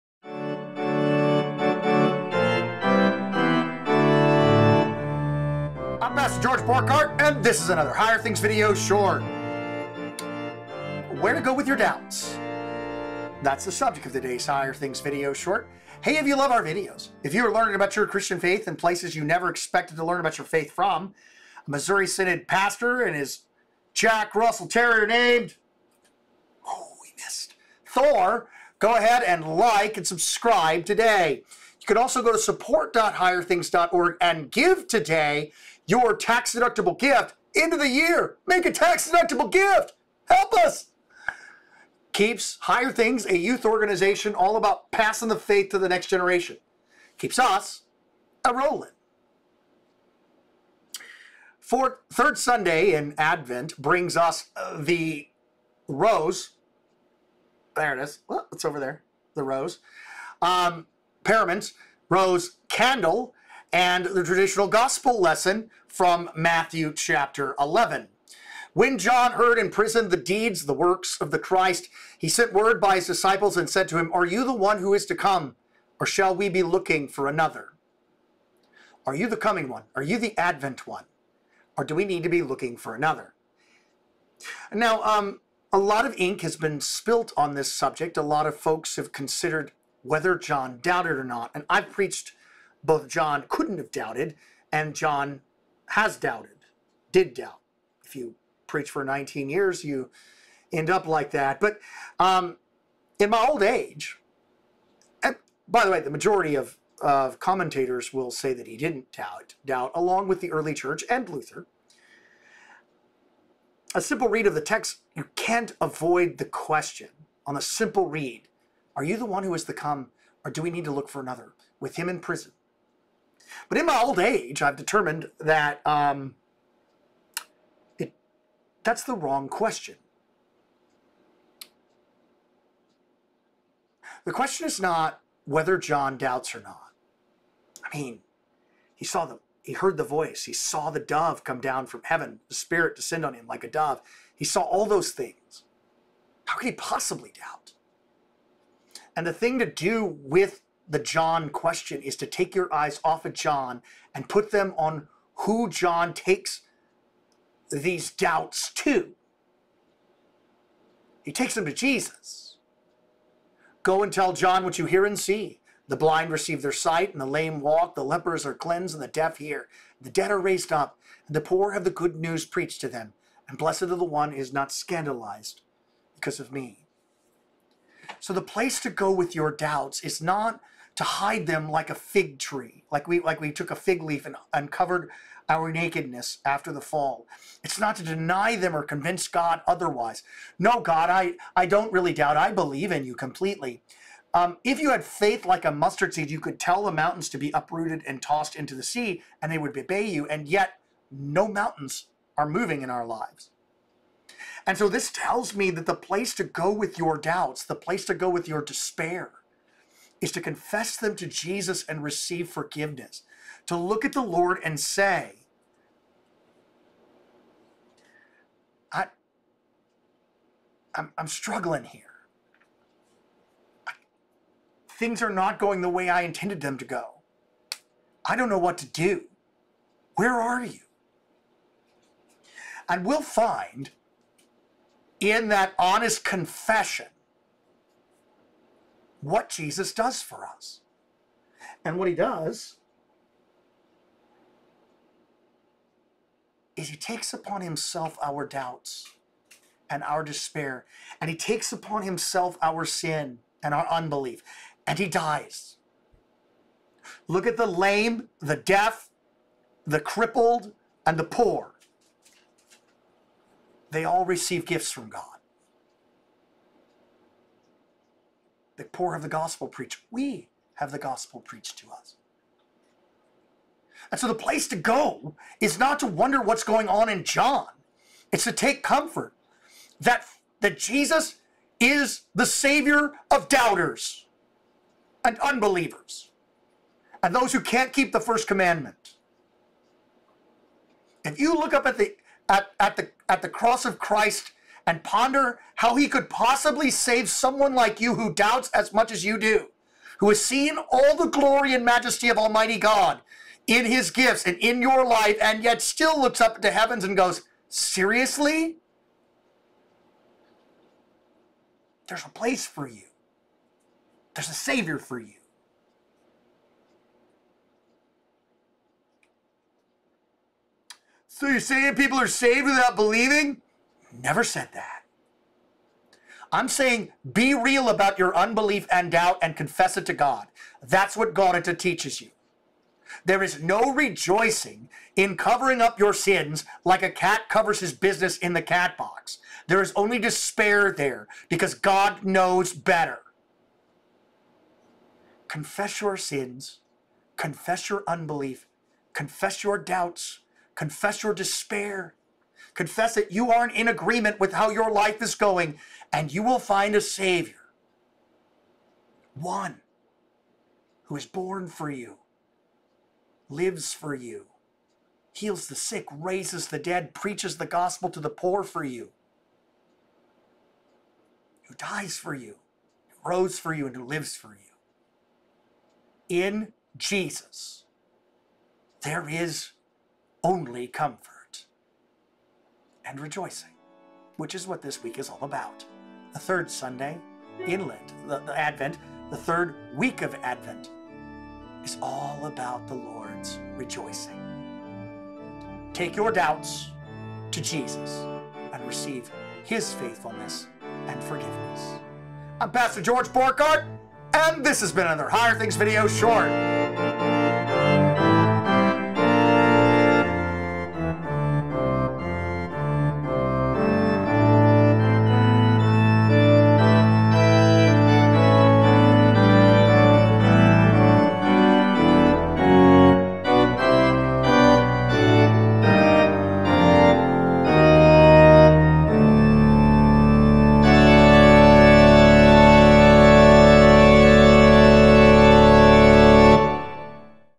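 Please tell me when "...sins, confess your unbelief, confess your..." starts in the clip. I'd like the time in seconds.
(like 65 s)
346 s.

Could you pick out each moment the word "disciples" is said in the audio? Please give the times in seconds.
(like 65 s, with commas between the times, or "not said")
73 s.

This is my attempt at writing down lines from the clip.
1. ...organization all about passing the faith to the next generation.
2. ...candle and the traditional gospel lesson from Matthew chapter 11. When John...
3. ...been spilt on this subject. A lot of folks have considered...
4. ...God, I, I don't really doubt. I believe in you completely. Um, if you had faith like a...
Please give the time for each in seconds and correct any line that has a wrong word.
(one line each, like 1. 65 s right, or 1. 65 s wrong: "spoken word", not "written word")
1. 43 s right
2. 62 s right
3. 86 s right
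4. 190 s right.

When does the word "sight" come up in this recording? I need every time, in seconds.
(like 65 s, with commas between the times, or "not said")
166 s.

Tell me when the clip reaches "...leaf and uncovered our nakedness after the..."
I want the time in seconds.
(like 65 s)
184 s.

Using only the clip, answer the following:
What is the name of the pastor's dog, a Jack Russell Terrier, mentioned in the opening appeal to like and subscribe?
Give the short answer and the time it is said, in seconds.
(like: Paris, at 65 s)
Thor, at 27 s.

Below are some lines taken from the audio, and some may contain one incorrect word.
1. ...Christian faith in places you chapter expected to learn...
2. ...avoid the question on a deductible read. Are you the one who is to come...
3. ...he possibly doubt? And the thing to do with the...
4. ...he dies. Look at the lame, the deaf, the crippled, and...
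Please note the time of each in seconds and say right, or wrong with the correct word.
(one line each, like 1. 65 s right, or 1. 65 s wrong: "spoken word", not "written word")
1. 18 s wrong: "never", not "chapter"
2. 115 s wrong: "simple", not "deductible"
3. 146 s right
4. 254 s right.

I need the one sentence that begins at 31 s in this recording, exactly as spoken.
You can also go to support.higherthings.org and give today your tax deductible gift into the year.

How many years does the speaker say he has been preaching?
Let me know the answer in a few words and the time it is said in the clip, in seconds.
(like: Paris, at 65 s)
19, at 99 s.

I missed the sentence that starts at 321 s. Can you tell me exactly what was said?
So you're saying people are saved without believing?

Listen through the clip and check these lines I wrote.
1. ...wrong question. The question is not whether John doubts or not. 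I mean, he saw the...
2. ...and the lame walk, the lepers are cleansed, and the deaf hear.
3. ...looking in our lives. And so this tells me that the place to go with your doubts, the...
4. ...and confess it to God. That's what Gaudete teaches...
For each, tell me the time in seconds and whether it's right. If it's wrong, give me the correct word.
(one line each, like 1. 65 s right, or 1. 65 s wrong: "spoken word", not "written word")
1. 129 s right
2. 167 s right
3. 202 s wrong: "moving", not "looking"
4. 329 s right.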